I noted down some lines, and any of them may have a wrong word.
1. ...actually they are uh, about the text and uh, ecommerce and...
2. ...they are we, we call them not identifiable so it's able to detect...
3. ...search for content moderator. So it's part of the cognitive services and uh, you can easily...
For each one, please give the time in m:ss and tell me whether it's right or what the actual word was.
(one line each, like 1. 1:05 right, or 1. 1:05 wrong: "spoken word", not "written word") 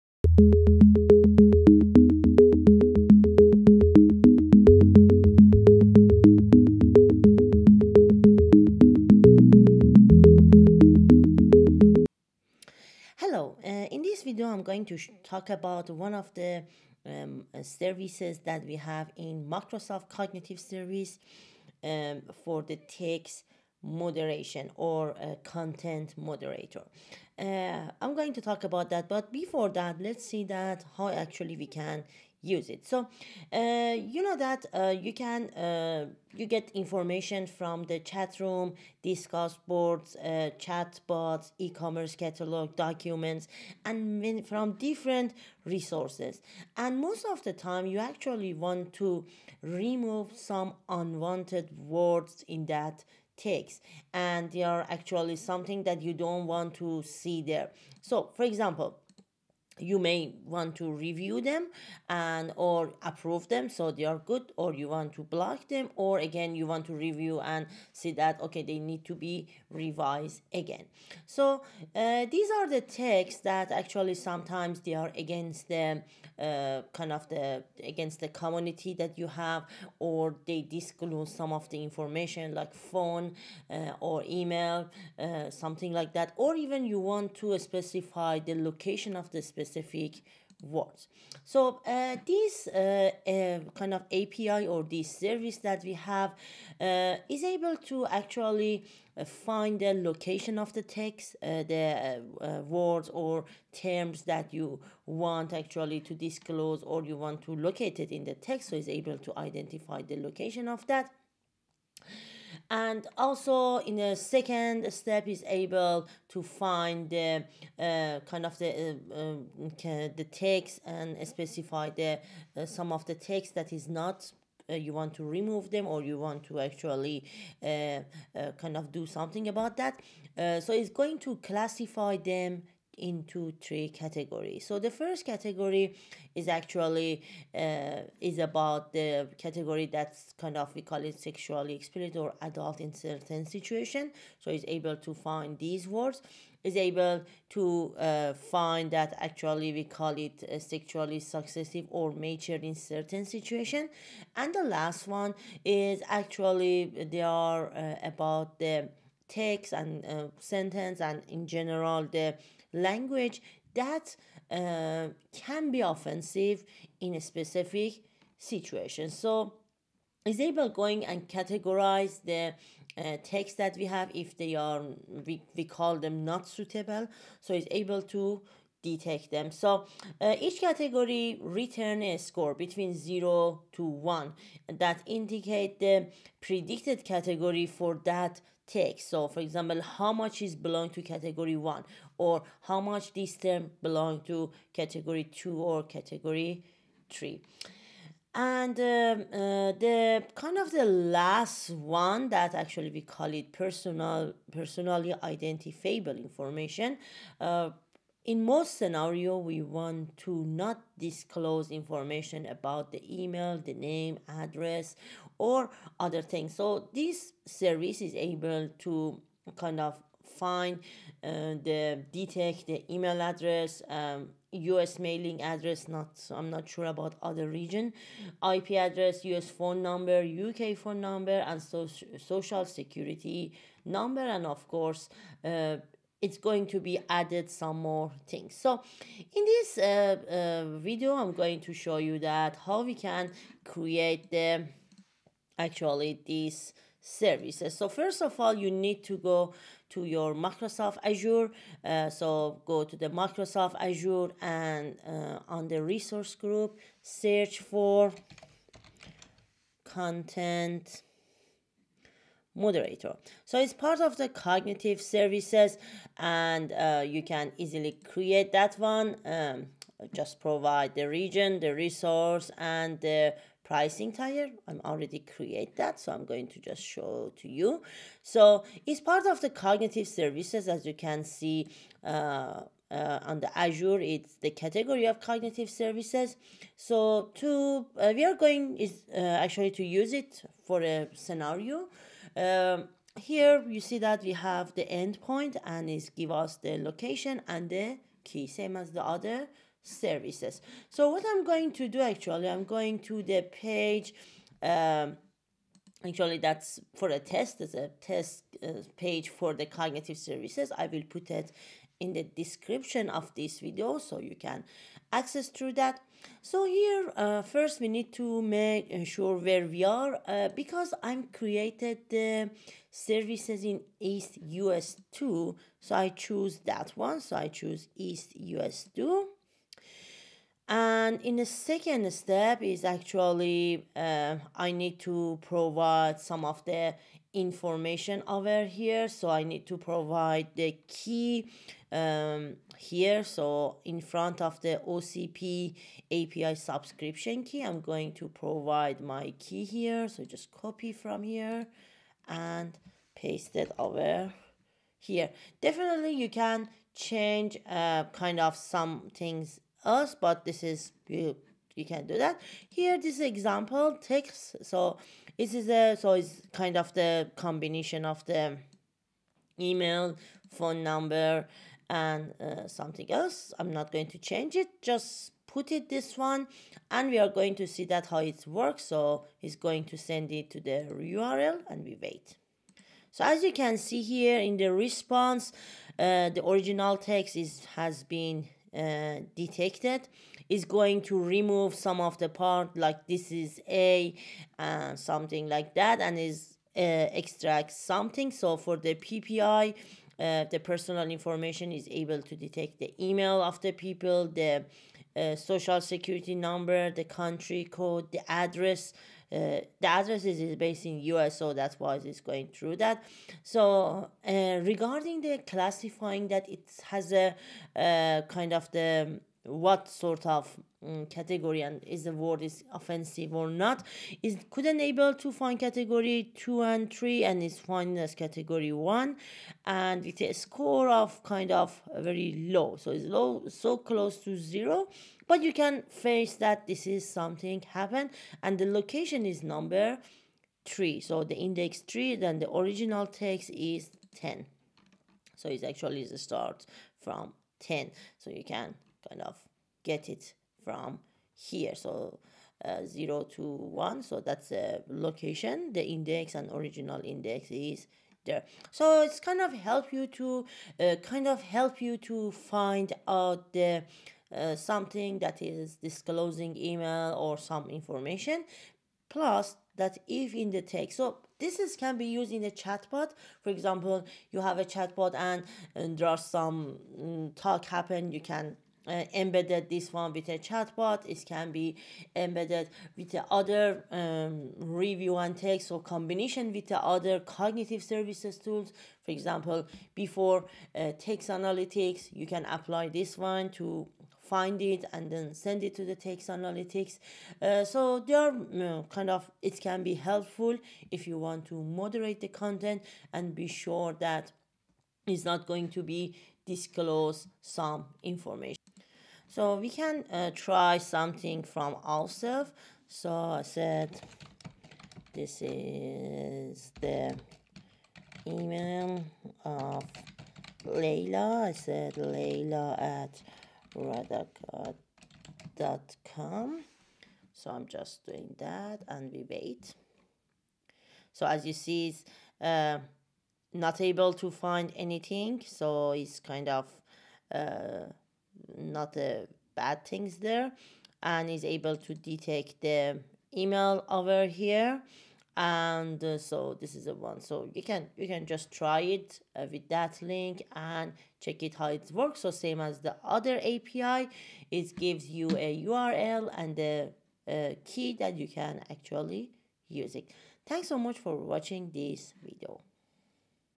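1. 2:36 wrong: "sentence", not "ecommerce"
2. 2:54 wrong: "suitable", not "identifiable"
3. 4:17 right.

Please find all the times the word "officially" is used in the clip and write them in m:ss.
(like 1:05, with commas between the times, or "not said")
not said.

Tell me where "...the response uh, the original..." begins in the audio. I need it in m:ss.
6:24.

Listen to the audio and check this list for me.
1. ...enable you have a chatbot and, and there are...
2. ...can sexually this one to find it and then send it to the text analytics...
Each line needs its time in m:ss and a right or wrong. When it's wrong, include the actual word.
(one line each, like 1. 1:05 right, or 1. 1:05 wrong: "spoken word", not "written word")
1. 7:53 wrong: "example", not "enable"
2. 8:12 wrong: "apply", not "sexually".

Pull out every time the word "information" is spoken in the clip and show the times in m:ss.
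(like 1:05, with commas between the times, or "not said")
0:36, 1:21, 3:26, 3:31, 5:37, 6:41, 7:47, 8:28.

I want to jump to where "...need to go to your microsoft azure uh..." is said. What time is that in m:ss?
4:08.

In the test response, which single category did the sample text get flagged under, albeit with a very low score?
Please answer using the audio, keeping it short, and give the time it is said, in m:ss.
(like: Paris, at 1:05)
category 1, at 7:08.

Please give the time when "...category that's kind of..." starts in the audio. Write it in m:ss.
2:19.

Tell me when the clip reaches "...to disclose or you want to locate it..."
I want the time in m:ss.
1:46.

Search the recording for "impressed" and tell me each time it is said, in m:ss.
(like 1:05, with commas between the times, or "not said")
not said.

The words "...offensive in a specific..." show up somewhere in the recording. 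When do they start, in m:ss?
2:45.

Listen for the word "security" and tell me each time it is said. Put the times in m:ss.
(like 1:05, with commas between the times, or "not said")
3:52, 6:45.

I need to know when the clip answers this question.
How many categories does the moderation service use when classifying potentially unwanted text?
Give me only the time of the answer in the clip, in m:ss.
2:13.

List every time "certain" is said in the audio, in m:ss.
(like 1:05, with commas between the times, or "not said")
2:22, 2:32.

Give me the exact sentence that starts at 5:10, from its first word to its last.
I will put it in the description of this video so you can access through that.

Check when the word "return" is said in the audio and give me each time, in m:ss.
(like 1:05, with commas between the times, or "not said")
3:01.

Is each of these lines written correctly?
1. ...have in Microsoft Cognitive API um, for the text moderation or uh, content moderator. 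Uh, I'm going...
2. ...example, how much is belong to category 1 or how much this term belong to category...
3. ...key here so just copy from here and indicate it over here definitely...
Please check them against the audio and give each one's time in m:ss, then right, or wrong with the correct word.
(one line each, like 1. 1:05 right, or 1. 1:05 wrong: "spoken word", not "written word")
1. 0:18 wrong: "Service", not "API"
2. 3:09 right
3. 5:49 wrong: "paste", not "indicate".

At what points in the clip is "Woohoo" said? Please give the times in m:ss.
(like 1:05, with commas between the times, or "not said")
not said.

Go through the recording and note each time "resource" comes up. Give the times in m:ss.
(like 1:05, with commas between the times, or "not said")
0:45, 4:15, 4:31.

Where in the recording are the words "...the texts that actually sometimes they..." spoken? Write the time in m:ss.
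1:12.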